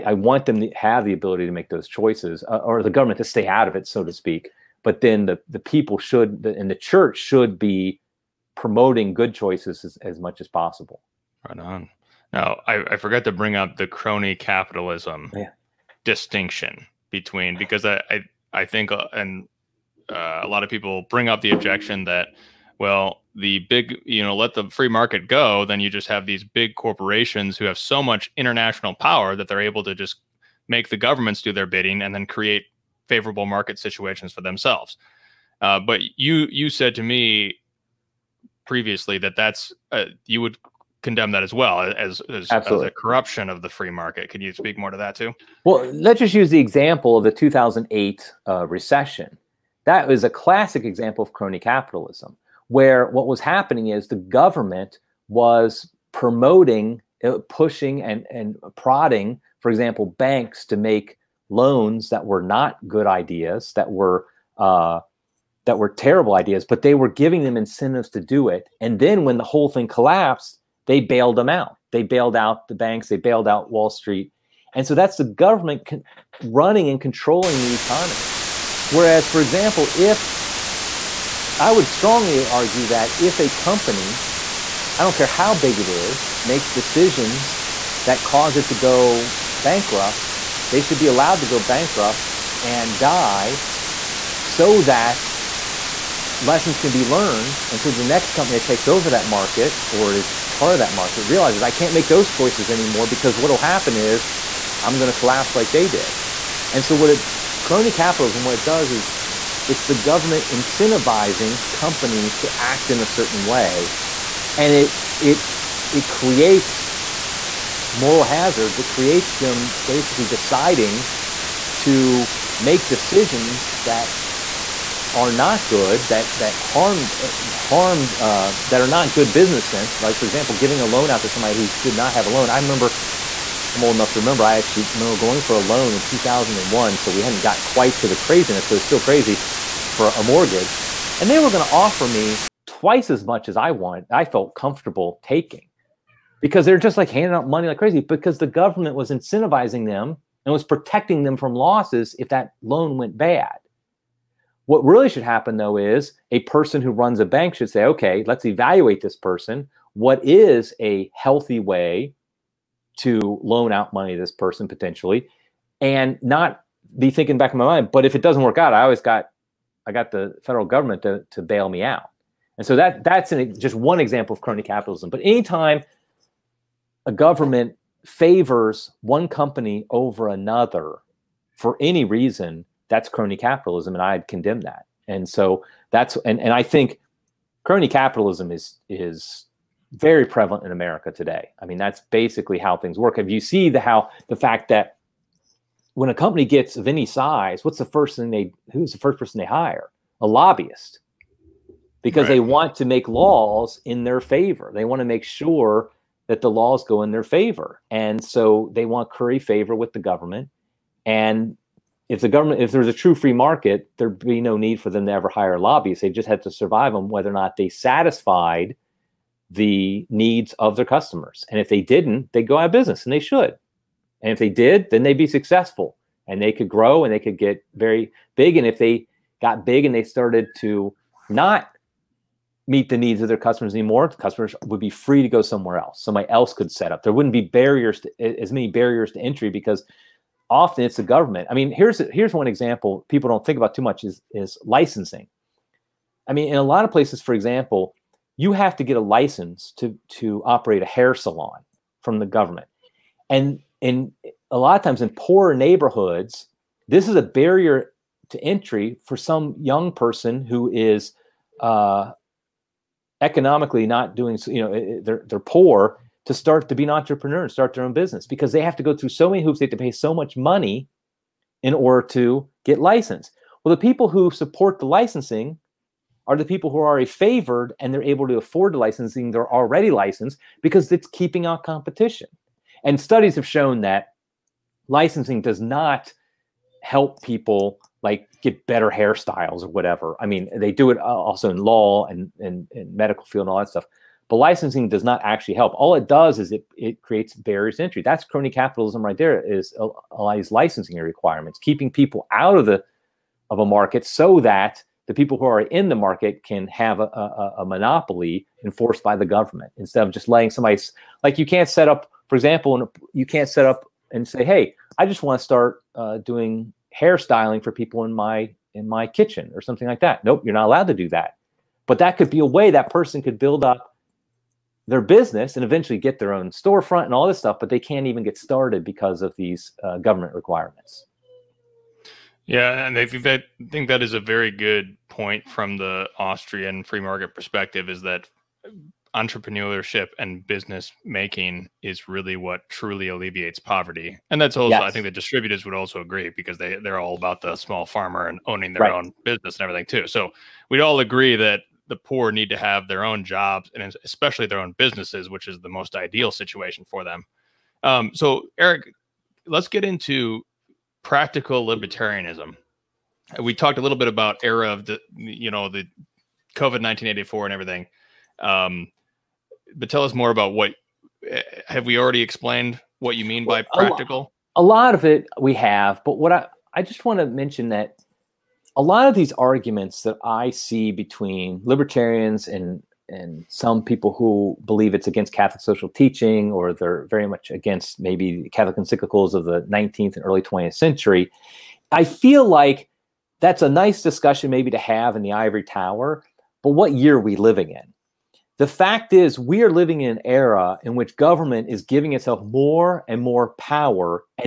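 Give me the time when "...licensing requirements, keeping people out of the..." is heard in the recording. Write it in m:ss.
5:00.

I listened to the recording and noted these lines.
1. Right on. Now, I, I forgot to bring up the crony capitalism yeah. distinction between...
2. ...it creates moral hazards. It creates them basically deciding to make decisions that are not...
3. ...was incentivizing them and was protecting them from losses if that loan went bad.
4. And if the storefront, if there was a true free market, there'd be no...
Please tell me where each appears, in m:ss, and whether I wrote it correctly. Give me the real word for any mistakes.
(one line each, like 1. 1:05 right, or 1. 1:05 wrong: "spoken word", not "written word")
1. 0:11 right
2. 1:55 right
3. 2:28 right
4. 3:31 wrong: "government", not "storefront".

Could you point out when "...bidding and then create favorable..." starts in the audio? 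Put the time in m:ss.
0:31.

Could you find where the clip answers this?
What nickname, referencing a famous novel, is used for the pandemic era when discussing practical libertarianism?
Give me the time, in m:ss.
6:06.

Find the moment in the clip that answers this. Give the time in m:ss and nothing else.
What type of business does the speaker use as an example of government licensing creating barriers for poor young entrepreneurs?
4:10.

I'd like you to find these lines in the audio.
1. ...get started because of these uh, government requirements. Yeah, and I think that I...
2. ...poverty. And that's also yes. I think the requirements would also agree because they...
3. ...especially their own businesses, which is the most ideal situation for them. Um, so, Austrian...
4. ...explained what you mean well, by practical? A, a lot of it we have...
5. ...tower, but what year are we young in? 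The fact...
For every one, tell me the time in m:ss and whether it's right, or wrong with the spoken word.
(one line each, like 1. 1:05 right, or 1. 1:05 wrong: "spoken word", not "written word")
1. 5:28 right
2. 5:43 wrong: "distributists", not "requirements"
3. 5:54 wrong: "Eric", not "Austrian"
4. 6:12 right
5. 6:35 wrong: "living", not "young".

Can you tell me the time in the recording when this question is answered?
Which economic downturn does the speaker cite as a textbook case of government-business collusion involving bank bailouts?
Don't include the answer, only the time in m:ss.
0:47.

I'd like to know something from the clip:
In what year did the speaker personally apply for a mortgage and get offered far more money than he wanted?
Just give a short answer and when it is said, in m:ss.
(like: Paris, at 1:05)
2001, at 2:16.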